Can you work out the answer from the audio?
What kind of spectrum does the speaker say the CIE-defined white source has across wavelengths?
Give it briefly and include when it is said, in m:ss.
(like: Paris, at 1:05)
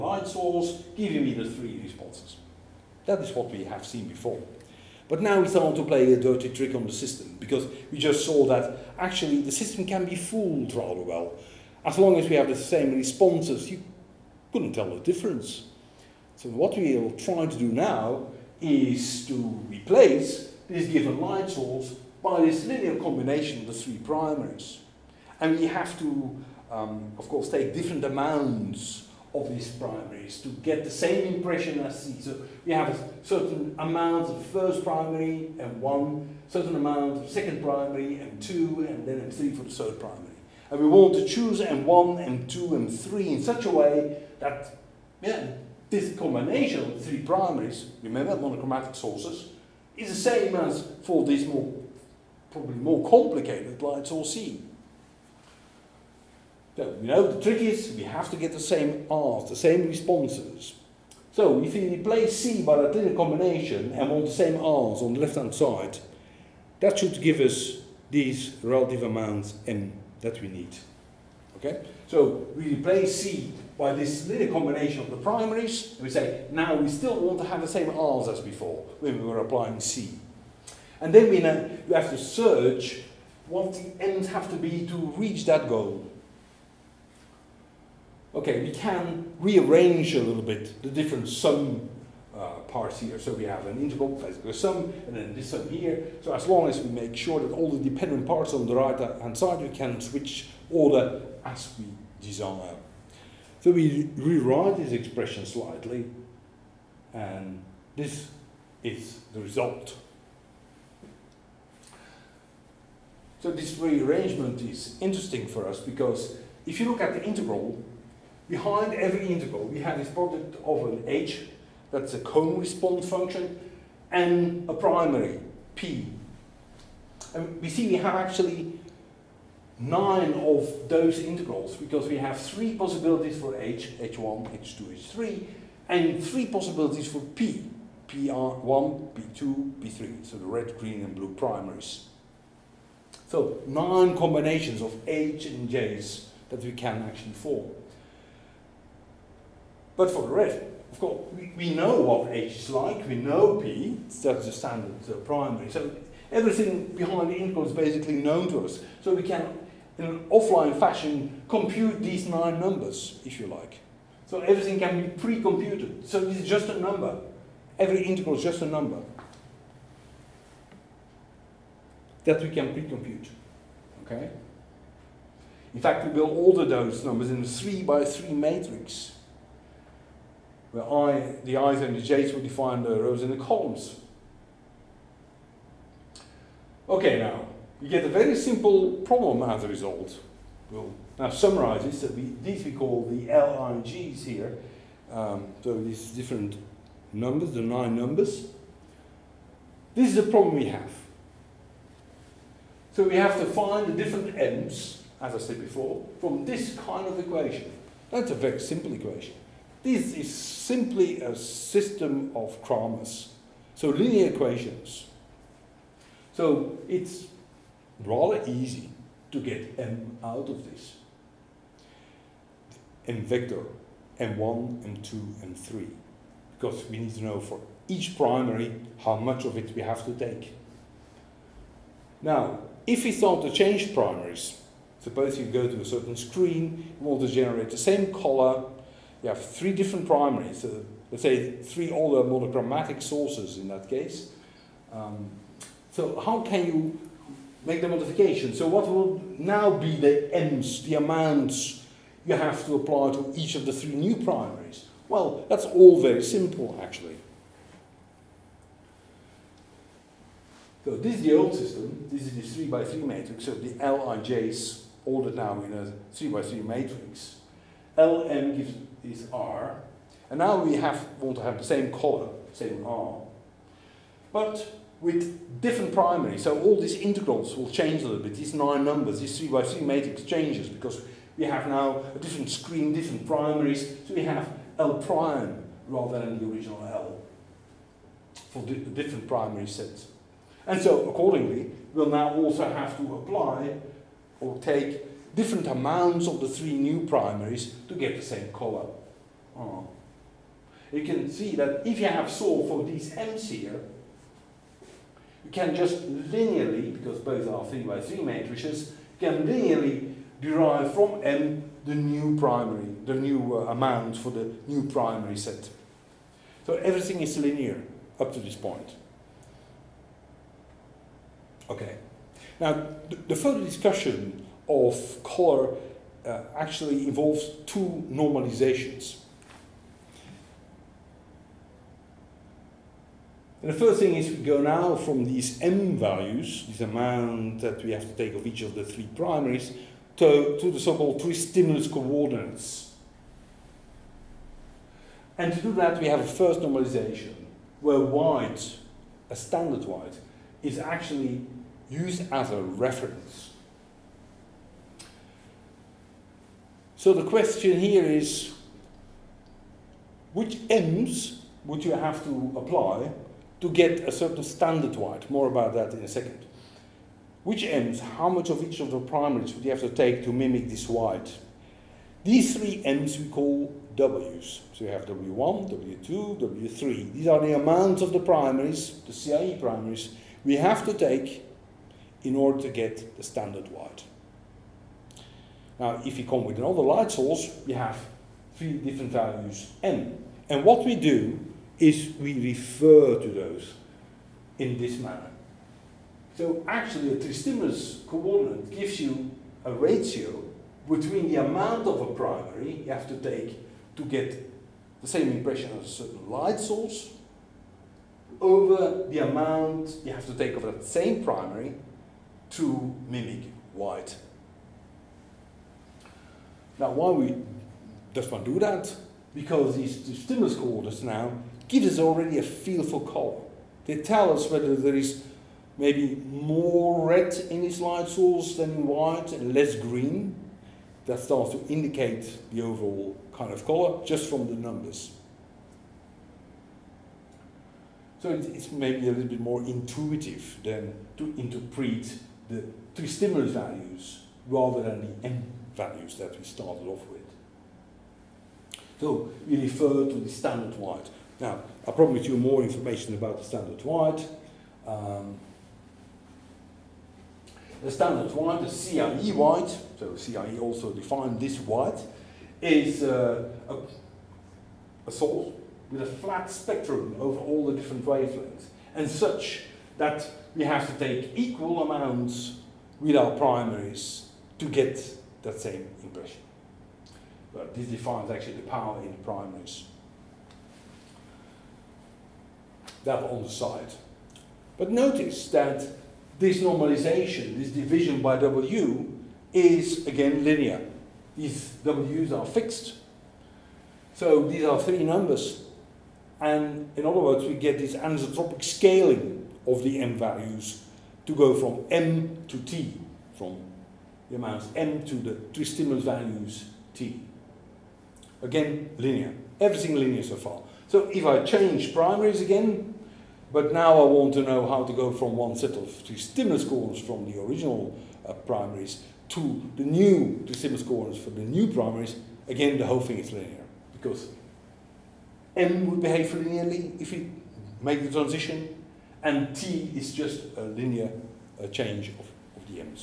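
Flat spectrum, at 7:46.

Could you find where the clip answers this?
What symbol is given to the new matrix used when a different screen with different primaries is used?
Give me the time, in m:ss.
4:44.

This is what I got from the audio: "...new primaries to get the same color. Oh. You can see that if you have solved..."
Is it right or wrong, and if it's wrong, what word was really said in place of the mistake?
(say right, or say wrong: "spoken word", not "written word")
right.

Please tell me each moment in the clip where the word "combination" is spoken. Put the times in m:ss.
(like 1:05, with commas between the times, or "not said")
0:22, 0:46, 1:03, 1:14, 2:24.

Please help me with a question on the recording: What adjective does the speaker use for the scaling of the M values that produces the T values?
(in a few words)
Anisotropic.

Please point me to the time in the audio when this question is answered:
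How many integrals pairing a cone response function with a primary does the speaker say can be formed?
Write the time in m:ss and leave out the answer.
2:09.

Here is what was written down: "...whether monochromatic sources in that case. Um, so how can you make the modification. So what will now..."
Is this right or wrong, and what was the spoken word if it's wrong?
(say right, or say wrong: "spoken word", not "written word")
wrong: "older", not "whether".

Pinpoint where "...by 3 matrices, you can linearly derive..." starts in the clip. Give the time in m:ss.
5:07.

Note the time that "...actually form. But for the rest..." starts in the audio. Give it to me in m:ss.
2:27.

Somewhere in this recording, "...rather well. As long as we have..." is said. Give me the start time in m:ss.
0:10.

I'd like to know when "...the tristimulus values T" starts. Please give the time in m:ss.
8:25.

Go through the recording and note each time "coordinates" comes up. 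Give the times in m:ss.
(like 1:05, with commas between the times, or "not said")
5:41, 6:38, 7:00, 8:36, 8:40.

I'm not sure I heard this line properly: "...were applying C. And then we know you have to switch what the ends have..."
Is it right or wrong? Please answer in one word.
wrong.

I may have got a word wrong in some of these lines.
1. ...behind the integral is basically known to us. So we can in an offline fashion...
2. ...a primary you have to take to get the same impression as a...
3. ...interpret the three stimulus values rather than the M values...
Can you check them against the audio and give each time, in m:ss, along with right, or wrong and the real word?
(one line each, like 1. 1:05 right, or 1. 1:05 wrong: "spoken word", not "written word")
1. 2:36 right
2. 6:41 right
3. 7:21 right.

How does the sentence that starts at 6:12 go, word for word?
These three M's we call W's.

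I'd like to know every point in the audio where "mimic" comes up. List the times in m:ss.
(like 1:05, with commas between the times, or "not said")
6:10, 6:53.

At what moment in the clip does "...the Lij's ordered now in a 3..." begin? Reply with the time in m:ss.
4:23.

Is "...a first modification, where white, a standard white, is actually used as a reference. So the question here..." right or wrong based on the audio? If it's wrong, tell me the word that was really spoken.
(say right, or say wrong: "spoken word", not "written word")
wrong: "normalization", not "modification".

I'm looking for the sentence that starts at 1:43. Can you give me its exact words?
So we rewrite this expression slightly, and this is the result.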